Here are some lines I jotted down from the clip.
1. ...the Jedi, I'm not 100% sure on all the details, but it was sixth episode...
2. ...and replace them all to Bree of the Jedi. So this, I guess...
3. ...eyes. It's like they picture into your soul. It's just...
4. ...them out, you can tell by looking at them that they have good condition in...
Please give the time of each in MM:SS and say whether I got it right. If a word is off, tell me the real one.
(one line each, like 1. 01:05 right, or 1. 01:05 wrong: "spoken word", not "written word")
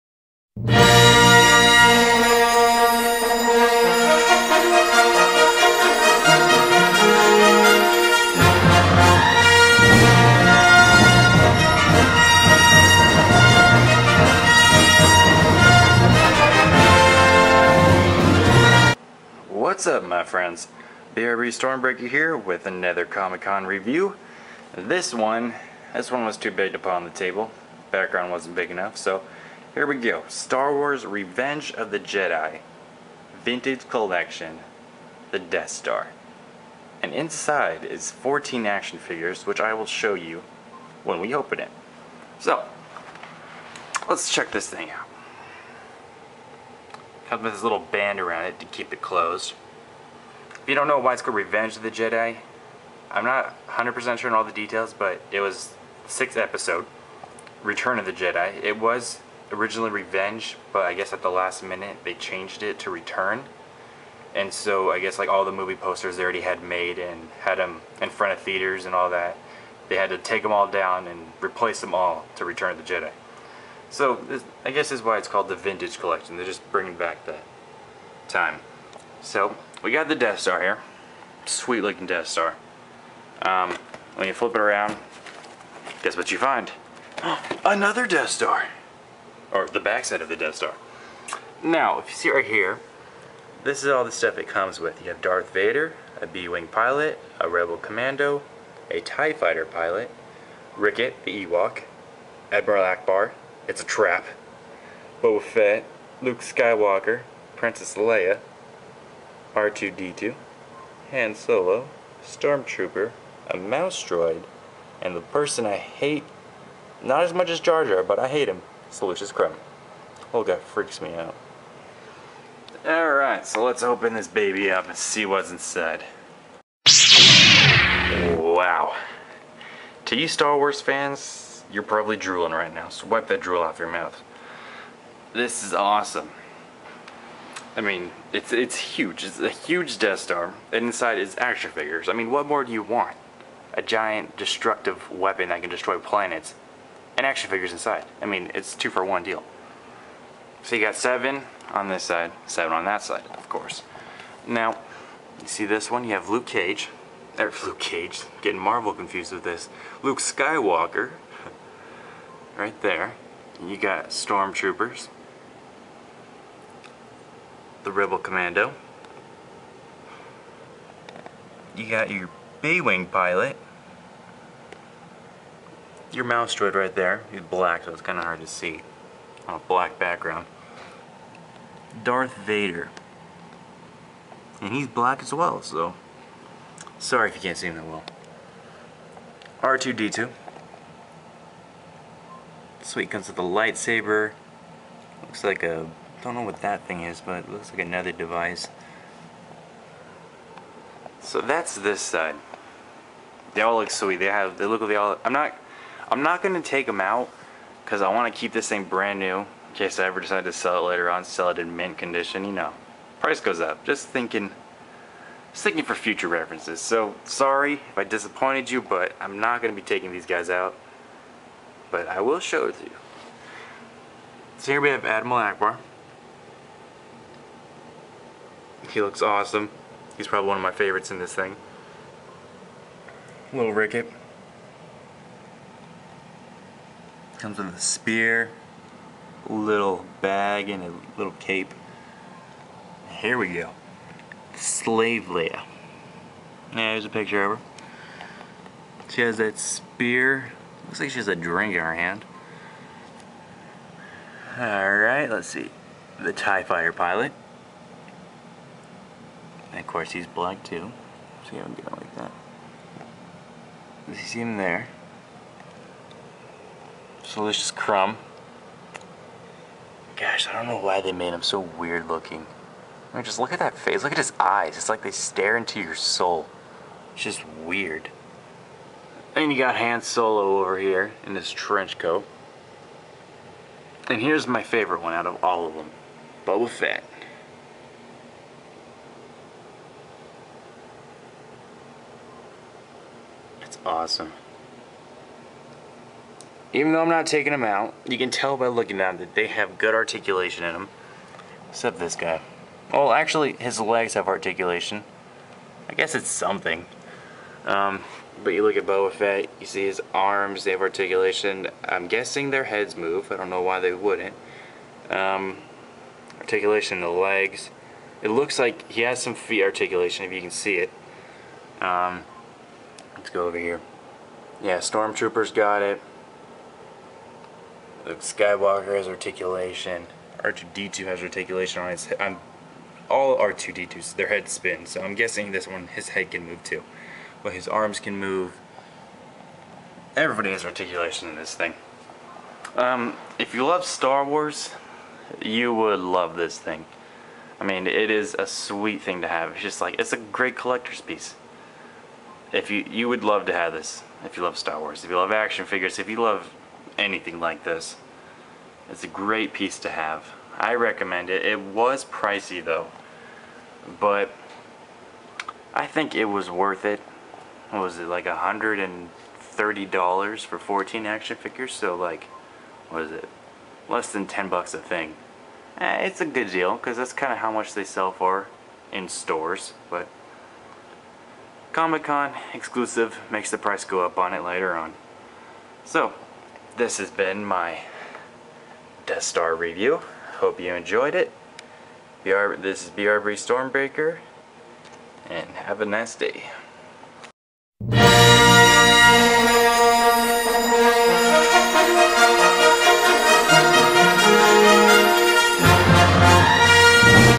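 1. 00:51 right
2. 01:11 wrong: "Return", not "Bree"
3. 04:34 wrong: "stare", not "picture"
4. 04:57 wrong: "articulation", not "condition".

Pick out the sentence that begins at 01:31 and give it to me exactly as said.
Now, if you see right here, this is all the stuff it comes with.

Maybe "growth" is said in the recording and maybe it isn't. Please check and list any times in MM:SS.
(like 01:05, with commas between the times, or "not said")
not said.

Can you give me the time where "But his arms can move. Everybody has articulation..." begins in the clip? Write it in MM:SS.
05:37.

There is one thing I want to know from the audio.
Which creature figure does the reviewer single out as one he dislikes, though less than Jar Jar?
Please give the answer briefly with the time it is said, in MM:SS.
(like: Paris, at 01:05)
Salacious Crumb, at 01:58.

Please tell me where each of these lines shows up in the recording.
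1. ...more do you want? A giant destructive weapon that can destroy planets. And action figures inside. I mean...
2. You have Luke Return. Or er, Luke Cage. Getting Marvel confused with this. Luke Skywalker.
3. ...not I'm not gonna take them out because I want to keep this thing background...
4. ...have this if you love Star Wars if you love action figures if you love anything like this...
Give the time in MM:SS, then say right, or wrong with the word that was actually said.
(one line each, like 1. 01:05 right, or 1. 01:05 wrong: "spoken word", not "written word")
1. 02:22 right
2. 02:36 wrong: "Cage", not "Return"
3. 03:25 wrong: "brand", not "background"
4. 05:53 right.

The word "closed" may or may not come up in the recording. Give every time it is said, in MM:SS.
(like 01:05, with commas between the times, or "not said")
00:48.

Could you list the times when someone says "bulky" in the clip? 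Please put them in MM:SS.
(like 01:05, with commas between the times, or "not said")
not said.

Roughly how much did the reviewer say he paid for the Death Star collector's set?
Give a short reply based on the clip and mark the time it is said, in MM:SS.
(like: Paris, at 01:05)
$130, at 06:08.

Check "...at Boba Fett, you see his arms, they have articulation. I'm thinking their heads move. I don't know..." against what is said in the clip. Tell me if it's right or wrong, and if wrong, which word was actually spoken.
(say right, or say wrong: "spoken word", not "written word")
wrong: "guessing", not "thinking".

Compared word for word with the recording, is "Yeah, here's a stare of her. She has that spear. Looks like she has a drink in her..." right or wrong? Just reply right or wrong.
wrong.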